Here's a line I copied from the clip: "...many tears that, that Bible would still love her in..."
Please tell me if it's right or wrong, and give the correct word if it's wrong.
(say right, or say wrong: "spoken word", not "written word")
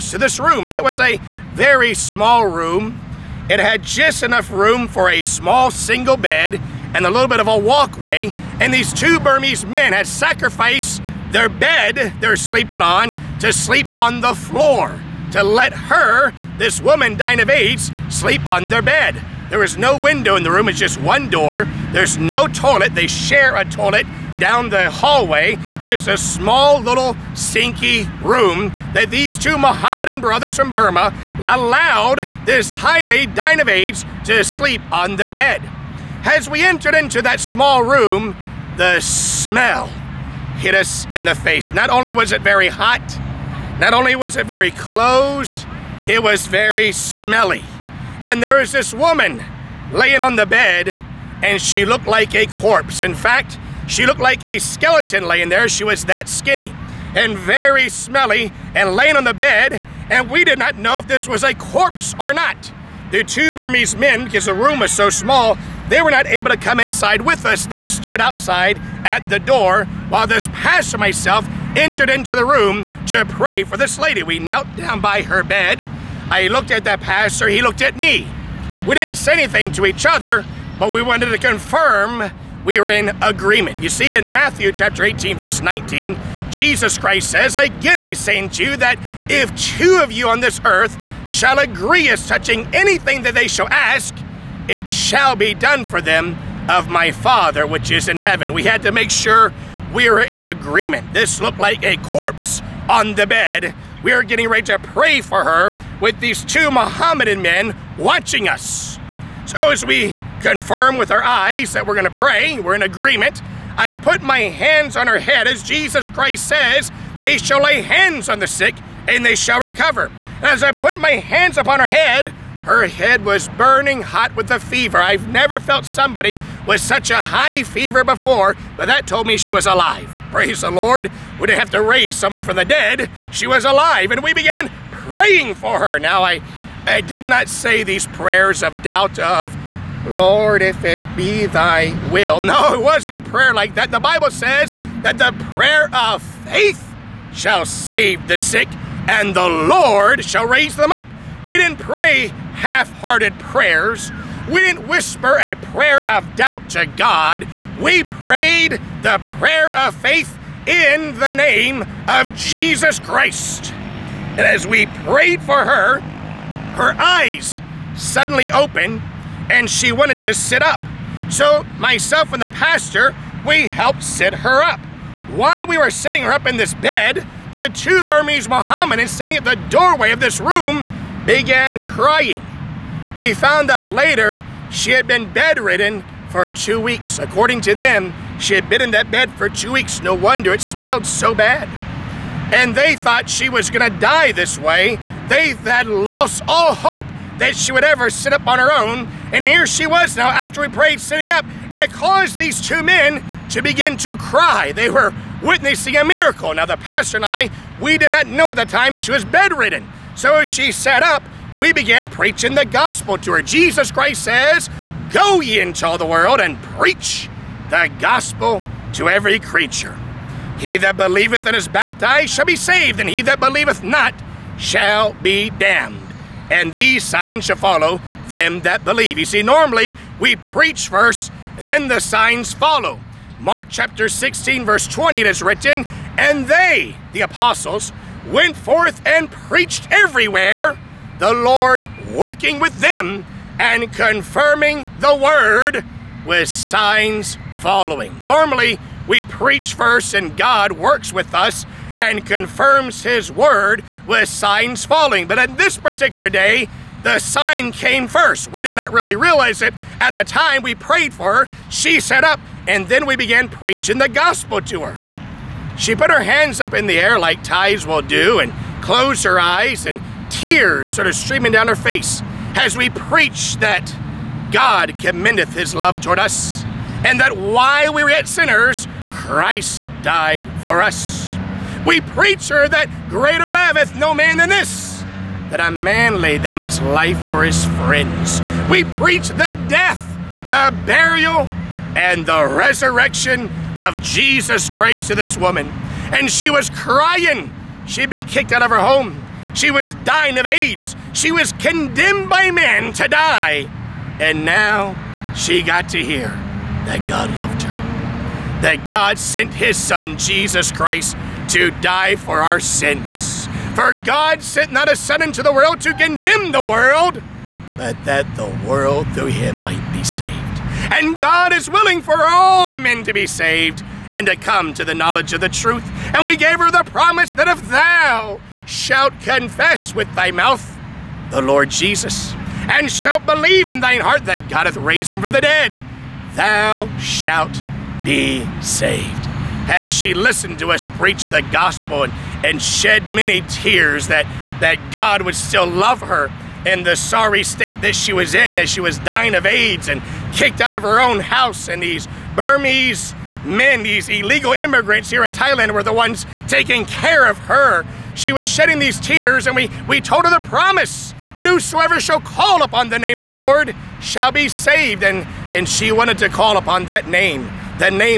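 wrong: "God", not "Bible".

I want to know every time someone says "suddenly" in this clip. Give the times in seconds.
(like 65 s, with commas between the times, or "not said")
167 s.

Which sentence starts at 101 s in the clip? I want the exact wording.
This looked like a corpse on the bed.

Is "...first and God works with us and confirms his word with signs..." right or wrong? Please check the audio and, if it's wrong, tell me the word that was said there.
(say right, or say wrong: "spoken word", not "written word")
right.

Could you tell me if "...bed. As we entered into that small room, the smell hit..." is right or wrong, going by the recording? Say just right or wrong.
right.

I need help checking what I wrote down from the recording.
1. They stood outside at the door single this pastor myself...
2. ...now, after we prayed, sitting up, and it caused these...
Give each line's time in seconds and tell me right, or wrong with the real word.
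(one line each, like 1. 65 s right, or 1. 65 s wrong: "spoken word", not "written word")
1. 67 s wrong: "while", not "single"
2. 200 s right.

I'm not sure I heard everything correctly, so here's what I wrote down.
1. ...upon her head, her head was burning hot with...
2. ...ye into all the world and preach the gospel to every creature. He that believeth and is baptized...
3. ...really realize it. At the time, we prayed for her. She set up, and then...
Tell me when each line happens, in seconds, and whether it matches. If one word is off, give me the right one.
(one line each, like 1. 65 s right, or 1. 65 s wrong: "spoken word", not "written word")
1. 121 s right
2. 215 s right
3. 258 s right.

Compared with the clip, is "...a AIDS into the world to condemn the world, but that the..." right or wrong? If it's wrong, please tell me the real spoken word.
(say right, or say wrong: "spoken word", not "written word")
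wrong: "Son", not "AIDS".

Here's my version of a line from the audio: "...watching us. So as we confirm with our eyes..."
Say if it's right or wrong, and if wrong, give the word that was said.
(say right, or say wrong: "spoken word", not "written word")
right.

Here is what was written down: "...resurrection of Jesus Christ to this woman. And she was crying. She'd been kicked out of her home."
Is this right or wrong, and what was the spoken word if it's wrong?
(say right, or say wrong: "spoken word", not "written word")
right.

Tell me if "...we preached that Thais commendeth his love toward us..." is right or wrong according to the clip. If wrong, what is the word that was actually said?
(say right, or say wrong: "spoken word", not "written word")
wrong: "God", not "Thais".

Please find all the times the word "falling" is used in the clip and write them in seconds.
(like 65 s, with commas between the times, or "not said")
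254 s.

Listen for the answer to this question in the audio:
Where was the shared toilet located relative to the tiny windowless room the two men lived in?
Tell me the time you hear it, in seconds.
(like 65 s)
24 s.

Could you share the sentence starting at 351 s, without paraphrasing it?
And these Burmese men, these illegal immigrants here in Thailand, were the ones taking care of her.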